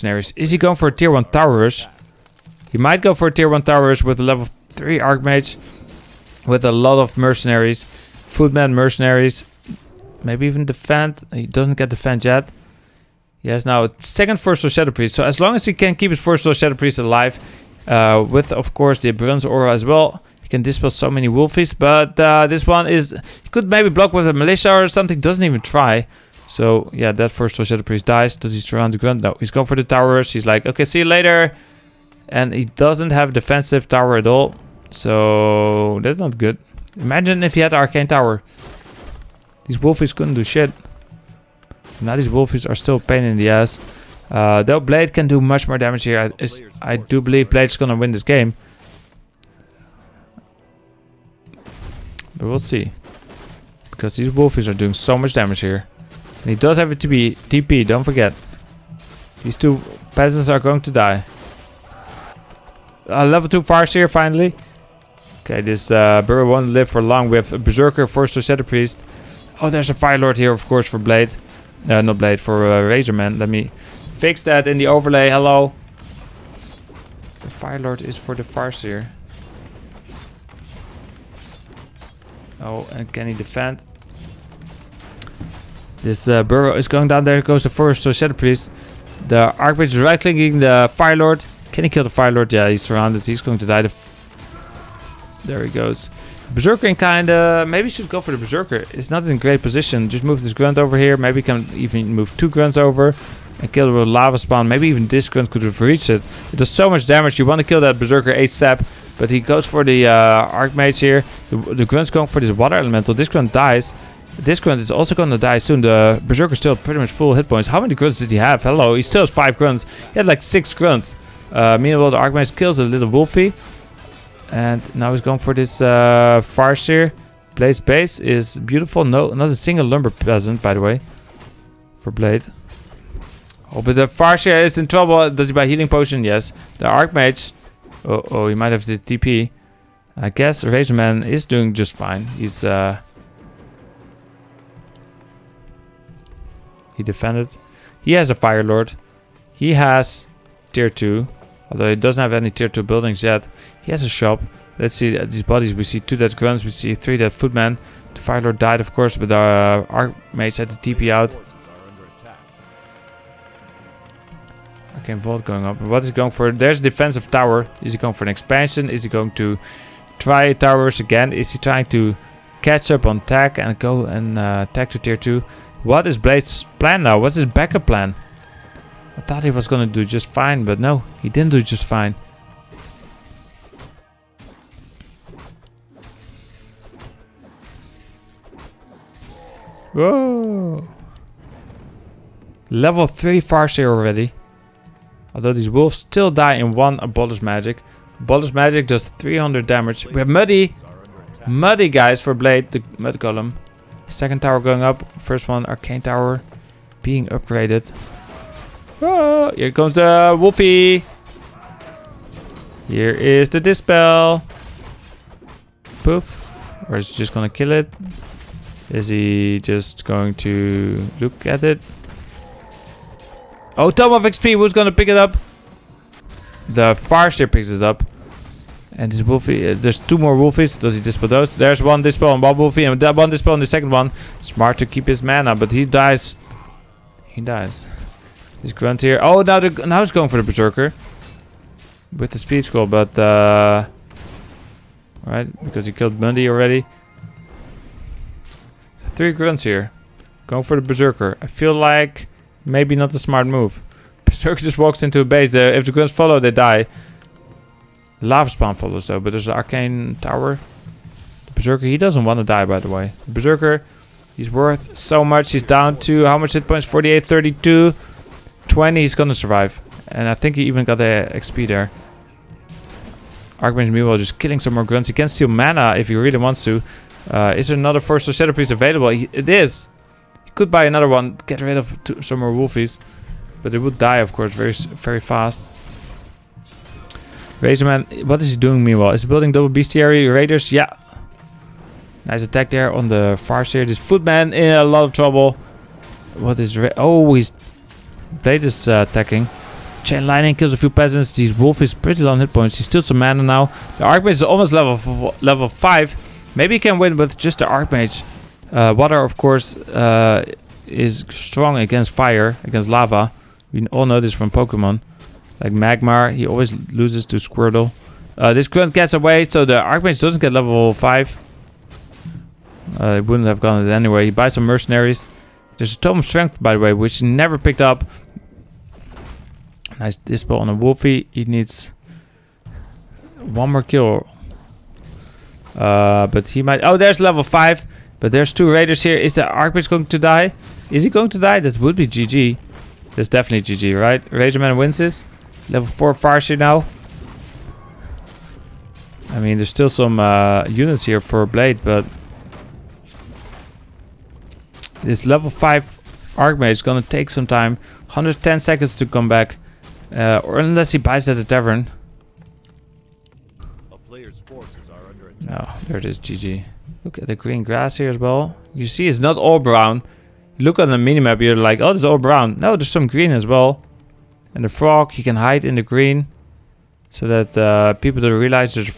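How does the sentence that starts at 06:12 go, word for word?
No, there's some green as well.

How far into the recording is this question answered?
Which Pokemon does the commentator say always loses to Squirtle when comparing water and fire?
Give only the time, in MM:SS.
05:15.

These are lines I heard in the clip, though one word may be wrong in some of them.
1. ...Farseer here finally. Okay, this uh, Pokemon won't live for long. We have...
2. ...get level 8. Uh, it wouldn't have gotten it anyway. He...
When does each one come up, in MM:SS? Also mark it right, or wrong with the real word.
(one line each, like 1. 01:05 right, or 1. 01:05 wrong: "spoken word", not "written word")
1. 01:03 wrong: "Burrow", not "Pokemon"
2. 05:20 wrong: "5", not "8".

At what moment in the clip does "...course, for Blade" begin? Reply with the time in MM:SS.
01:10.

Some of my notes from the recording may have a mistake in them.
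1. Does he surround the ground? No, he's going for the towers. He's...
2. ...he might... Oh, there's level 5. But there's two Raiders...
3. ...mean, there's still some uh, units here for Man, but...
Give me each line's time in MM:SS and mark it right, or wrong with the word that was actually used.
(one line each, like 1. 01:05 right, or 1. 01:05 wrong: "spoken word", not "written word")
1. 00:28 right
2. 05:36 right
3. 05:49 wrong: "Blade", not "Man".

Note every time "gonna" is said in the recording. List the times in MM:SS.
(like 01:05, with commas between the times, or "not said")
00:47, 02:59, 03:37, 03:44, 04:29, 05:56.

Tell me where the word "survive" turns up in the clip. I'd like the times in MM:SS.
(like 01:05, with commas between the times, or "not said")
04:29.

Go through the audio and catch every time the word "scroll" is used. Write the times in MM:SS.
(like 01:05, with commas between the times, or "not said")
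04:02.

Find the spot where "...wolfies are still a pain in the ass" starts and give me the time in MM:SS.
00:42.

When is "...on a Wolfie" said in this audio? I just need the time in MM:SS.
05:30.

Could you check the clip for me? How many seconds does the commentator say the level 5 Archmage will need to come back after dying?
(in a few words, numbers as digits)
110 seconds.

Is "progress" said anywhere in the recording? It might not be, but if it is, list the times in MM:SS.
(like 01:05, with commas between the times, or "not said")
not said.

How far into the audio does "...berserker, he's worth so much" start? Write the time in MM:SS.
04:23.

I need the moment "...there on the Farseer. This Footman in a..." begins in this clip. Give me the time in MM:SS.
04:52.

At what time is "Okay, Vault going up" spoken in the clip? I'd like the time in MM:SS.
02:44.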